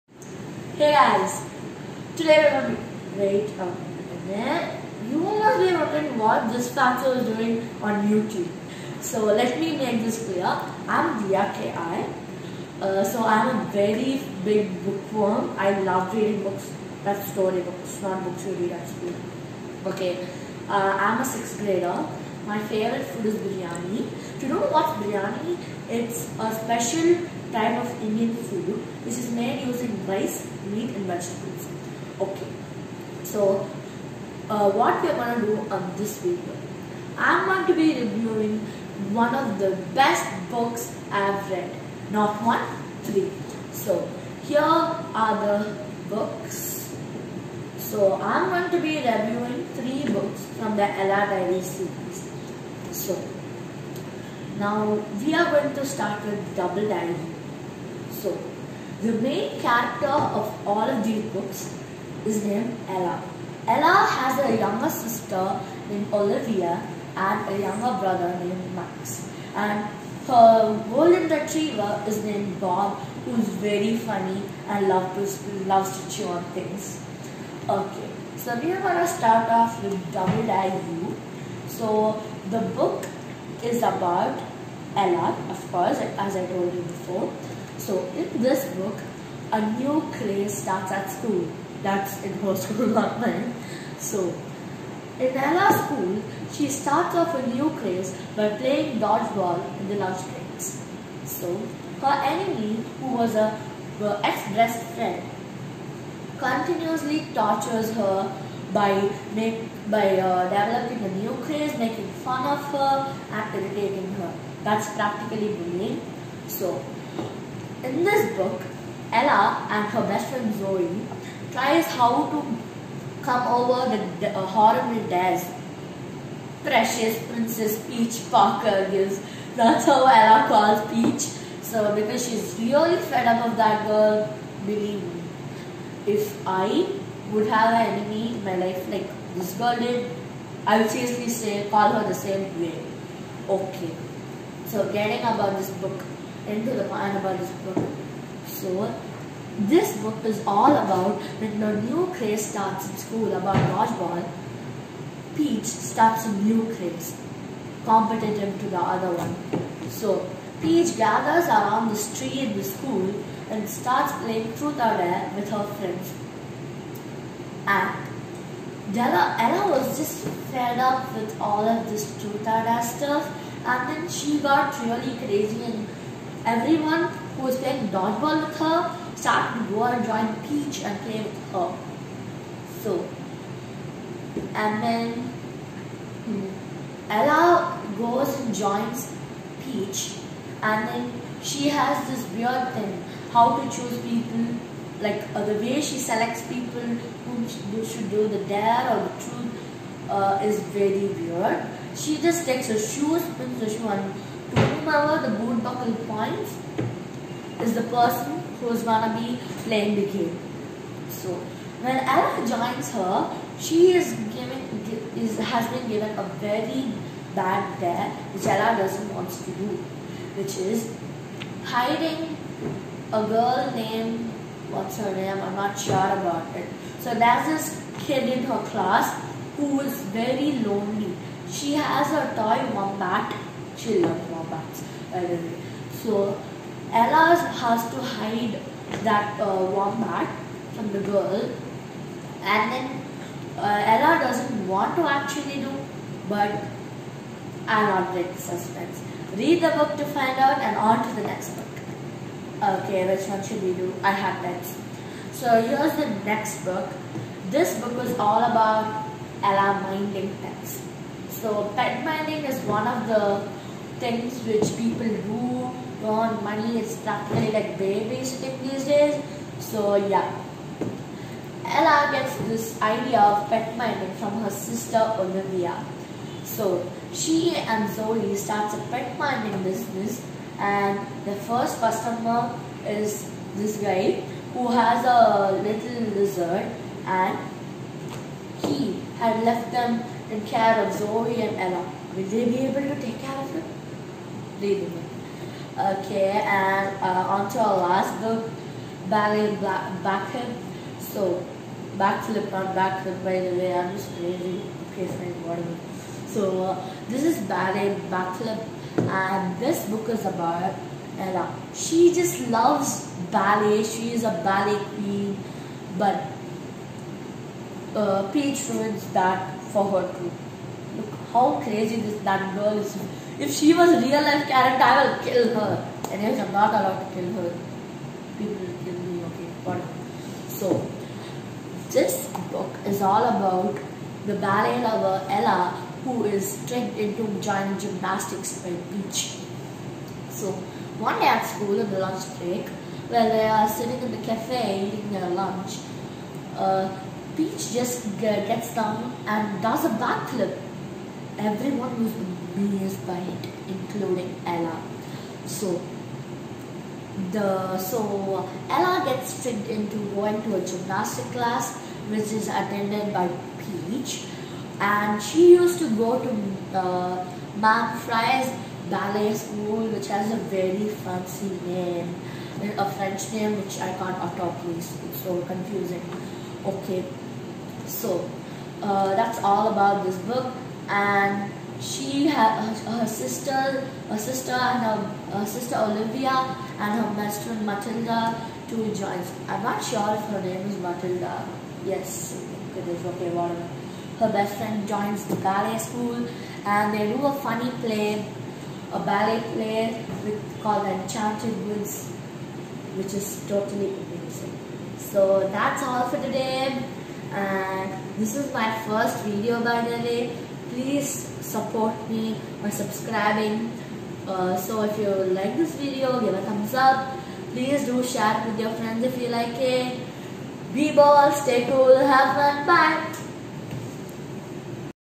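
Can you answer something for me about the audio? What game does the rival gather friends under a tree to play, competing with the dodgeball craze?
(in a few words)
Truth or dare.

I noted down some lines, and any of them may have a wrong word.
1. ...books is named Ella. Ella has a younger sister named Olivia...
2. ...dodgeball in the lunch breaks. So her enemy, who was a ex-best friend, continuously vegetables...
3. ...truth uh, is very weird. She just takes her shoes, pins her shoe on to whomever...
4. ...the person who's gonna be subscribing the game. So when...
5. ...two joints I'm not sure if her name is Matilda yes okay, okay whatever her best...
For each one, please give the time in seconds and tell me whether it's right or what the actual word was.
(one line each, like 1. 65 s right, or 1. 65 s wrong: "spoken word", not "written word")
1. 61 s right
2. 98 s wrong: "tortures", not "vegetables"
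3. 199 s right
4. 207 s wrong: "playing", not "subscribing"
5. 388 s right.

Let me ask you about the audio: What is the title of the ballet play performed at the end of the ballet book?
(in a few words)
Enchanted Woods.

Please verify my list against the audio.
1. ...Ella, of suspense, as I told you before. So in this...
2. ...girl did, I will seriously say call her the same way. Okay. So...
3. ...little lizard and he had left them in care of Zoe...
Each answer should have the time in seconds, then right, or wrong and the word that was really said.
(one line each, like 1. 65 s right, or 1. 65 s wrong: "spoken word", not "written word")
1. 84 s wrong: "course", not "suspense"
2. 139 s right
3. 285 s right.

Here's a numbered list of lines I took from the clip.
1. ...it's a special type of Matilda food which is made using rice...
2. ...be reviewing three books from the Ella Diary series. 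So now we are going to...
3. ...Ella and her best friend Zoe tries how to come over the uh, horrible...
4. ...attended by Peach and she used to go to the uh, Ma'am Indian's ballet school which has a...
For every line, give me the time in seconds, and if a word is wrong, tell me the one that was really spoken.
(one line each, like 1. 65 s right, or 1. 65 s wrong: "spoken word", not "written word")
1. 25 s wrong: "Indian", not "Matilda"
2. 48 s right
3. 119 s right
4. 362 s wrong: "Fry", not "Indian".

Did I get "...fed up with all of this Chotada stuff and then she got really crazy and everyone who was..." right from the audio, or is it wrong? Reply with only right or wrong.
right.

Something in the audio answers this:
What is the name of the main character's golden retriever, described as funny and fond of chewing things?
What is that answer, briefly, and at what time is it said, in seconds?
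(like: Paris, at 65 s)
Bob, at 72 s.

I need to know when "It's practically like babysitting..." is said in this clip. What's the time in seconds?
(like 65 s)
266 s.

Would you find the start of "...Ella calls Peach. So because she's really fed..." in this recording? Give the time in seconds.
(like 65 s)
130 s.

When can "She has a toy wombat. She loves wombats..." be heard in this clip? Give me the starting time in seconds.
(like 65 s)
231 s.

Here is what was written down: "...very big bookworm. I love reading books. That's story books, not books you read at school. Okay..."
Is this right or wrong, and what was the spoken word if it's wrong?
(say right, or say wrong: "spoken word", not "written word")
right.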